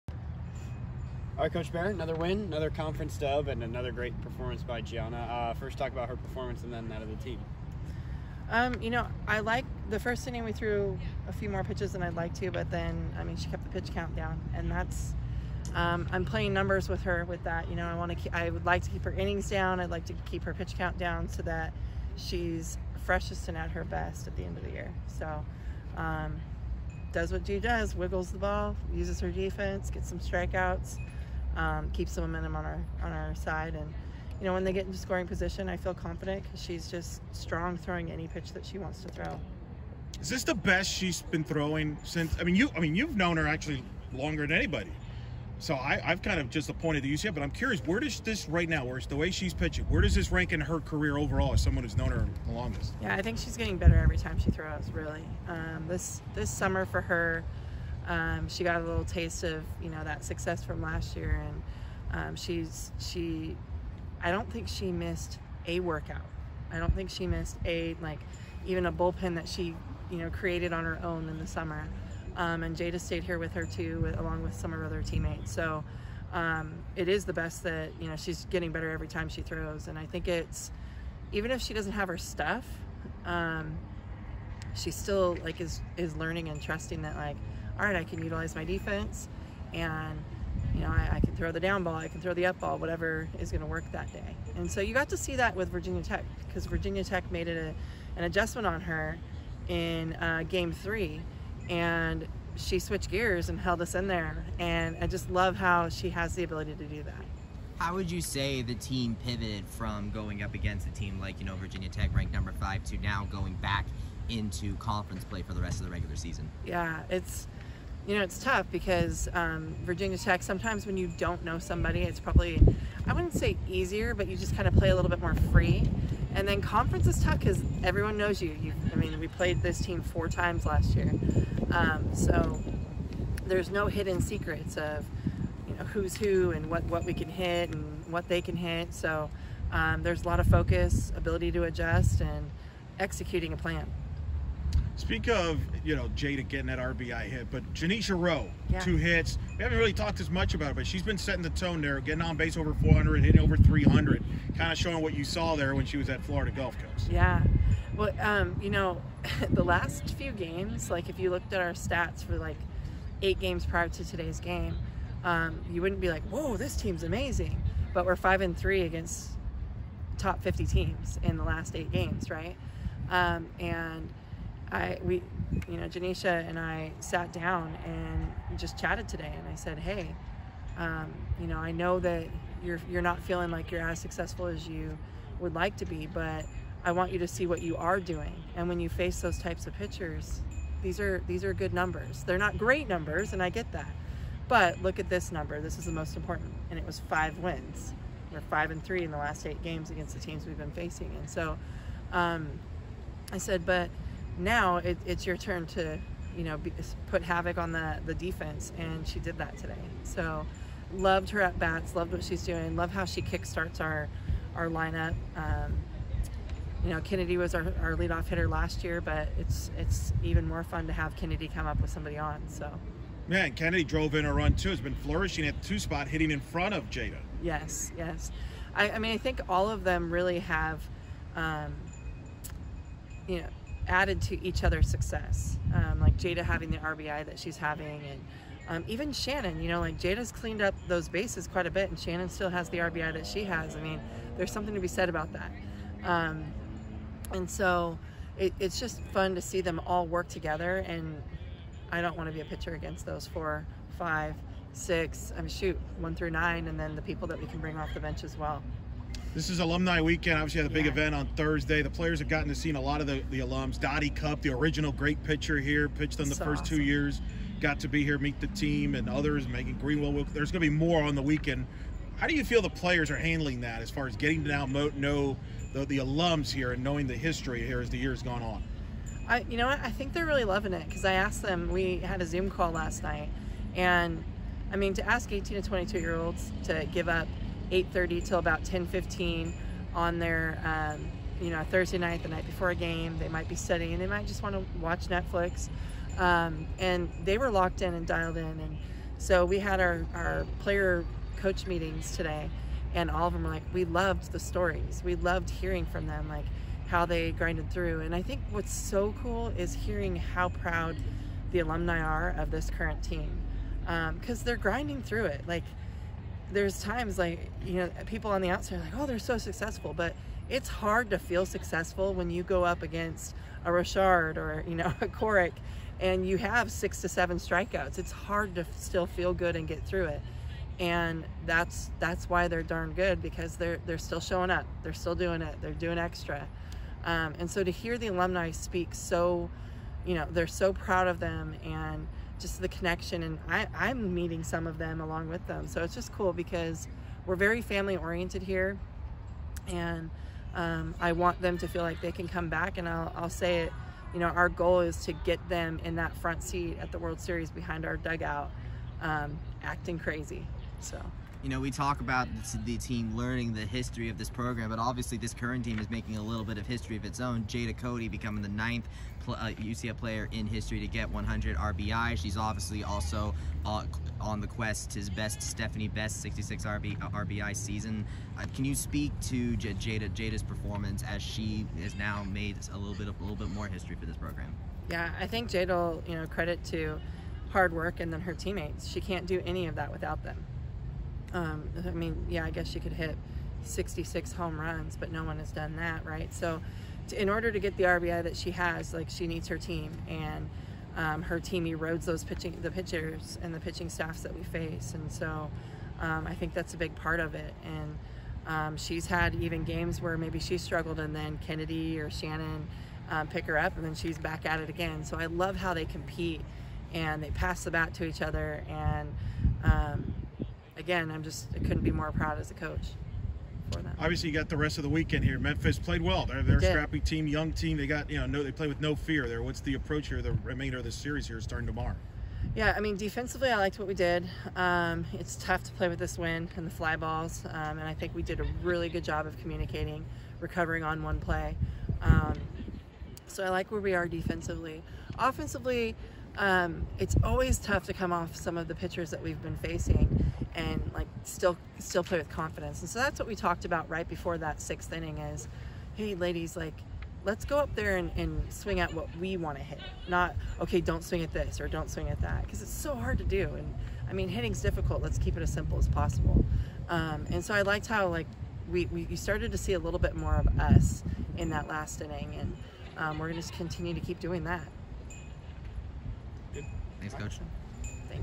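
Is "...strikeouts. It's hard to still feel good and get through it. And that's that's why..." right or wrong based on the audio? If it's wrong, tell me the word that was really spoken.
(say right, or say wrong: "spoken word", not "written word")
right.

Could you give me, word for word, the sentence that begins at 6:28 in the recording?
She can't do any of that without them.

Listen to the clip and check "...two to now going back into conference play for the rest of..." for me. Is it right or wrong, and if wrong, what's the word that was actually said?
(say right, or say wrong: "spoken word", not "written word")
wrong: "five", not "two".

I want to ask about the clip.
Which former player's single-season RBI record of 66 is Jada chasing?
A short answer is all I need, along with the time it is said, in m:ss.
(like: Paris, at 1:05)
Stephanie Best, at 6:15.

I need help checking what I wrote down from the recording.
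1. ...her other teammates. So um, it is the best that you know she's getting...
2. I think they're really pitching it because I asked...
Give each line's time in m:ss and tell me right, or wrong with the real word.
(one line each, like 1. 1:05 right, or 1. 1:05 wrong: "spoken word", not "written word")
1. 1:14 right
2. 4:39 wrong: "loving", not "pitching".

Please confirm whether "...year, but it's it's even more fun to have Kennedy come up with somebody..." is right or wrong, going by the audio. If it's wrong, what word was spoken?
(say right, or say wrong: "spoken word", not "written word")
right.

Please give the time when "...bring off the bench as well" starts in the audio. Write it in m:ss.
4:17.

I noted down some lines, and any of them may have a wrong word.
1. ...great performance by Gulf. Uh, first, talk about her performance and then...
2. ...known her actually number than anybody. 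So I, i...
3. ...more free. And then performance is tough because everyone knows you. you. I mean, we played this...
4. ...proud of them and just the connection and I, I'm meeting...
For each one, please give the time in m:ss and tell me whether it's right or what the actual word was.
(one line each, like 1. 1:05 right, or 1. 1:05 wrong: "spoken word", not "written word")
1. 0:03 wrong: "Gianna", not "Gulf"
2. 0:43 wrong: "longer", not "number"
3. 2:05 wrong: "conference", not "performance"
4. 5:40 right.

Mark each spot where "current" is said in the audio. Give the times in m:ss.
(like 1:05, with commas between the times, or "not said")
5:12, 6:05.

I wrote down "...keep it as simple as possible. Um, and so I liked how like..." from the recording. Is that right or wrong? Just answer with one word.
right.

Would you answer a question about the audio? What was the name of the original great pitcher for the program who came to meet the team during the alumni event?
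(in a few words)
Dottie Cup.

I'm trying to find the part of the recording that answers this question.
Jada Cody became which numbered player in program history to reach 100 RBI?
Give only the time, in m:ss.
6:08.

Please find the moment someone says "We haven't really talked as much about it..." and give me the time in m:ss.
2:29.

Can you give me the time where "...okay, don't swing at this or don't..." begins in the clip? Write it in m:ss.
7:40.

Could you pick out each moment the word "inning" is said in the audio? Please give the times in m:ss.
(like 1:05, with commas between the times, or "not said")
0:10, 0:19, 7:34, 7:52.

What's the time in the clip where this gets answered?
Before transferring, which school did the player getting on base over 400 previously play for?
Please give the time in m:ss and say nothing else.
2:36.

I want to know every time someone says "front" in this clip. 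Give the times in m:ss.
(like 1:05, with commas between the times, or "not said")
3:46, 5:56.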